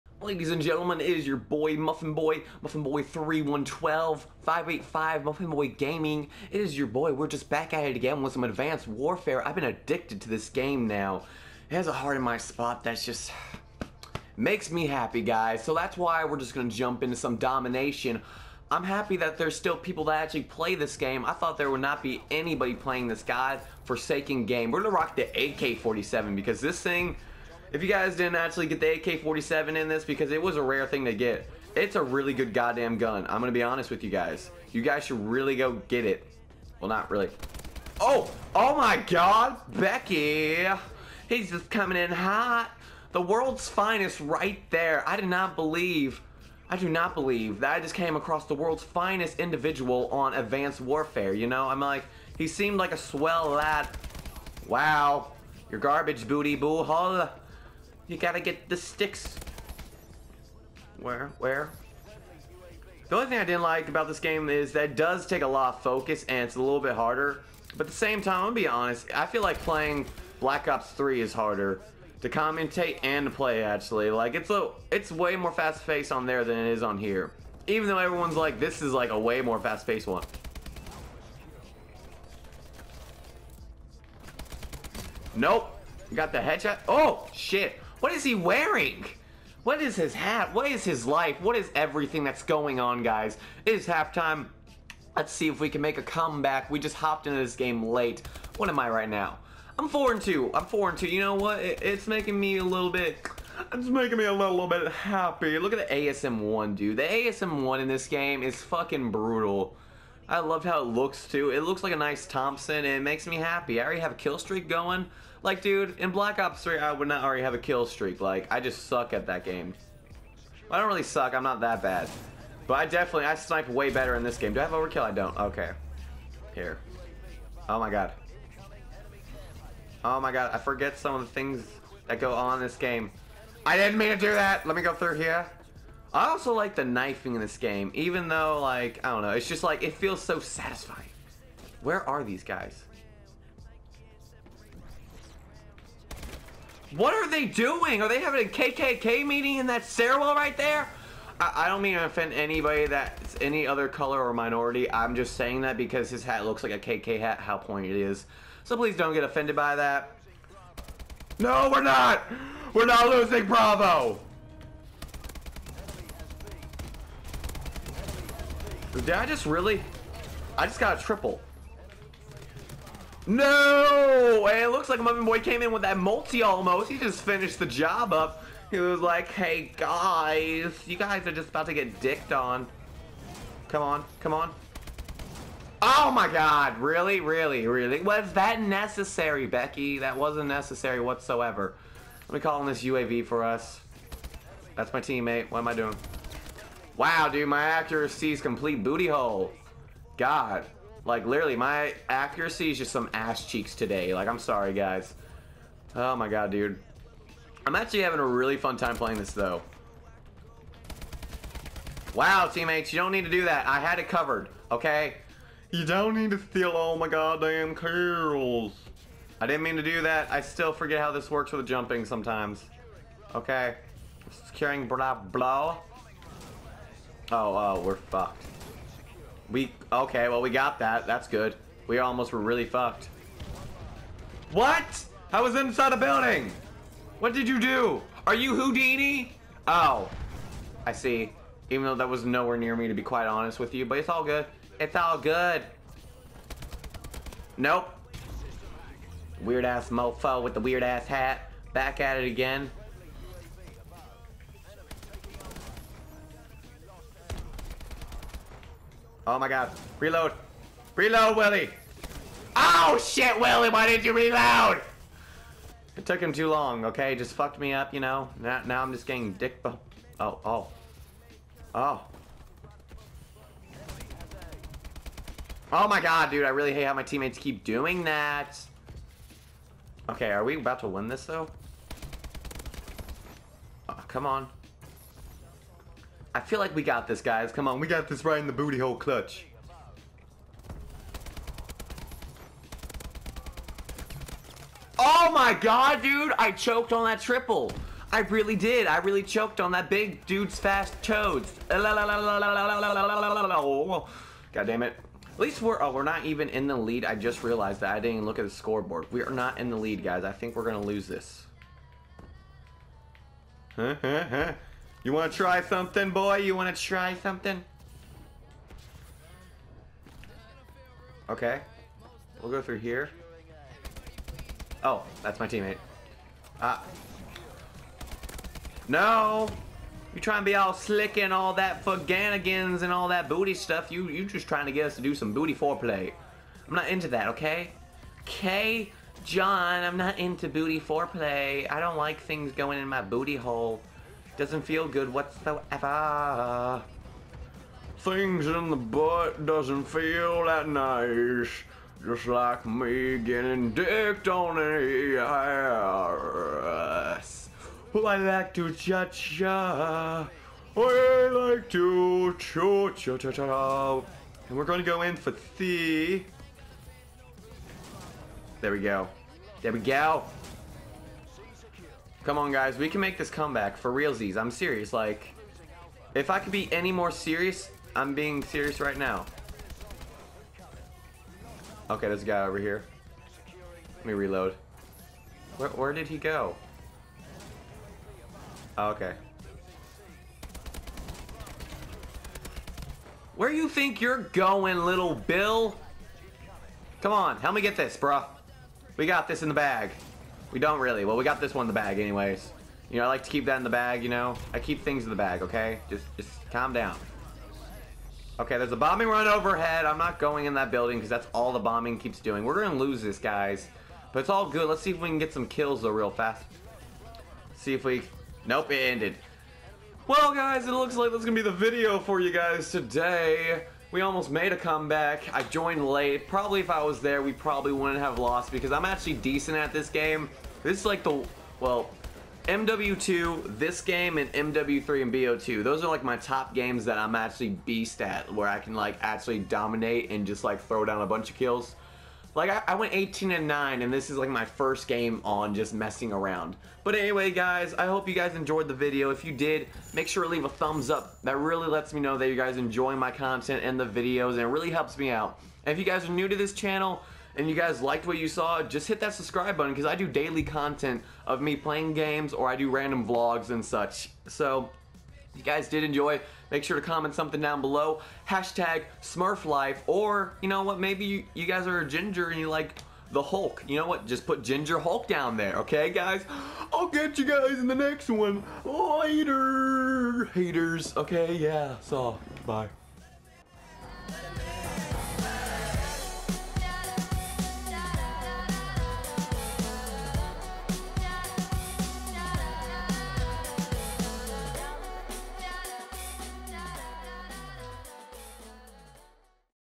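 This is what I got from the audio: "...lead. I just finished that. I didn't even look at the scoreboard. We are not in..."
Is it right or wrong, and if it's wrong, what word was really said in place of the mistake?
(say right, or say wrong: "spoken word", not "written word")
wrong: "realized", not "finished".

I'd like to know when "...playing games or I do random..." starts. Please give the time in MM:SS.
07:41.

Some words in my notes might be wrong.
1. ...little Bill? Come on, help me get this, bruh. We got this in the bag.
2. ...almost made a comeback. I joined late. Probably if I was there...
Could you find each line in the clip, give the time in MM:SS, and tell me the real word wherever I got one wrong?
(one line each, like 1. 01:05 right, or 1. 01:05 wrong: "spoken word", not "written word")
1. 06:34 right
2. 07:04 right.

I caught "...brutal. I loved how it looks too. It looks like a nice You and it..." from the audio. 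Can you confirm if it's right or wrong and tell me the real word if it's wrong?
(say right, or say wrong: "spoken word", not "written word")
wrong: "Thompson", not "You".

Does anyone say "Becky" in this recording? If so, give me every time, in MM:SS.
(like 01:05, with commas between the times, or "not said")
00:39, 03:09.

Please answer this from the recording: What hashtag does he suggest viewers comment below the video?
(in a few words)
SmurfLife.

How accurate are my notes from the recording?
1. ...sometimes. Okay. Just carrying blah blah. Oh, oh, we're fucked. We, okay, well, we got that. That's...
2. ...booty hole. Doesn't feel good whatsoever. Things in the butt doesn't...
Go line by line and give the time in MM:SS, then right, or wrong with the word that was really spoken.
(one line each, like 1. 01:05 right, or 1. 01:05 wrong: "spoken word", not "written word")
1. 03:42 right
2. 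05:43 right.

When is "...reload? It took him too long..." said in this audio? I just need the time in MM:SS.
04:24.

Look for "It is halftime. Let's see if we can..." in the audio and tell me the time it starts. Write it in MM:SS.
01:33.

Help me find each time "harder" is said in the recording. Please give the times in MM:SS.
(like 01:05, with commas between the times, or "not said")
01:06, 01:11.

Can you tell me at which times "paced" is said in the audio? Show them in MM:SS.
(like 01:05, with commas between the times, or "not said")
01:15, 01:19.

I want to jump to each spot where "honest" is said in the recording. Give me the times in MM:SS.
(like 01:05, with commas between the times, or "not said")
00:33, 01:08, 04:03.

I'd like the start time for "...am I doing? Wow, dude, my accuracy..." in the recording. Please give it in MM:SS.
03:15.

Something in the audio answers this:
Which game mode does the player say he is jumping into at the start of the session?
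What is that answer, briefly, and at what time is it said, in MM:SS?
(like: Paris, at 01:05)
Domination, at 00:17.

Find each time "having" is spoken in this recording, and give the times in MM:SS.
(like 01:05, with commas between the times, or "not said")
02:28, 03:28.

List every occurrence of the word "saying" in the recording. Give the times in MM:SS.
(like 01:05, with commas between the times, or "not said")
02:35.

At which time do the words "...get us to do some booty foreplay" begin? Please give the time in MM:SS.
05:34.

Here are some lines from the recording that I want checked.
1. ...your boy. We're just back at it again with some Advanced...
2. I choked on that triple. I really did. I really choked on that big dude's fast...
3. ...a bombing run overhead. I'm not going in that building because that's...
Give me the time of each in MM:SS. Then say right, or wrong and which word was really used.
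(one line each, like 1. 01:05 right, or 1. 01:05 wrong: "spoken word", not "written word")
1. 00:06 right
2. 04:56 right
3. 06:48 right.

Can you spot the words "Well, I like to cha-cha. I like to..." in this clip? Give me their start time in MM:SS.
05:57.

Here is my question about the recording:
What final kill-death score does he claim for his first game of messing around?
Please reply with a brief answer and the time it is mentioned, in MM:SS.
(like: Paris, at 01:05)
18 and 9, at 07:22.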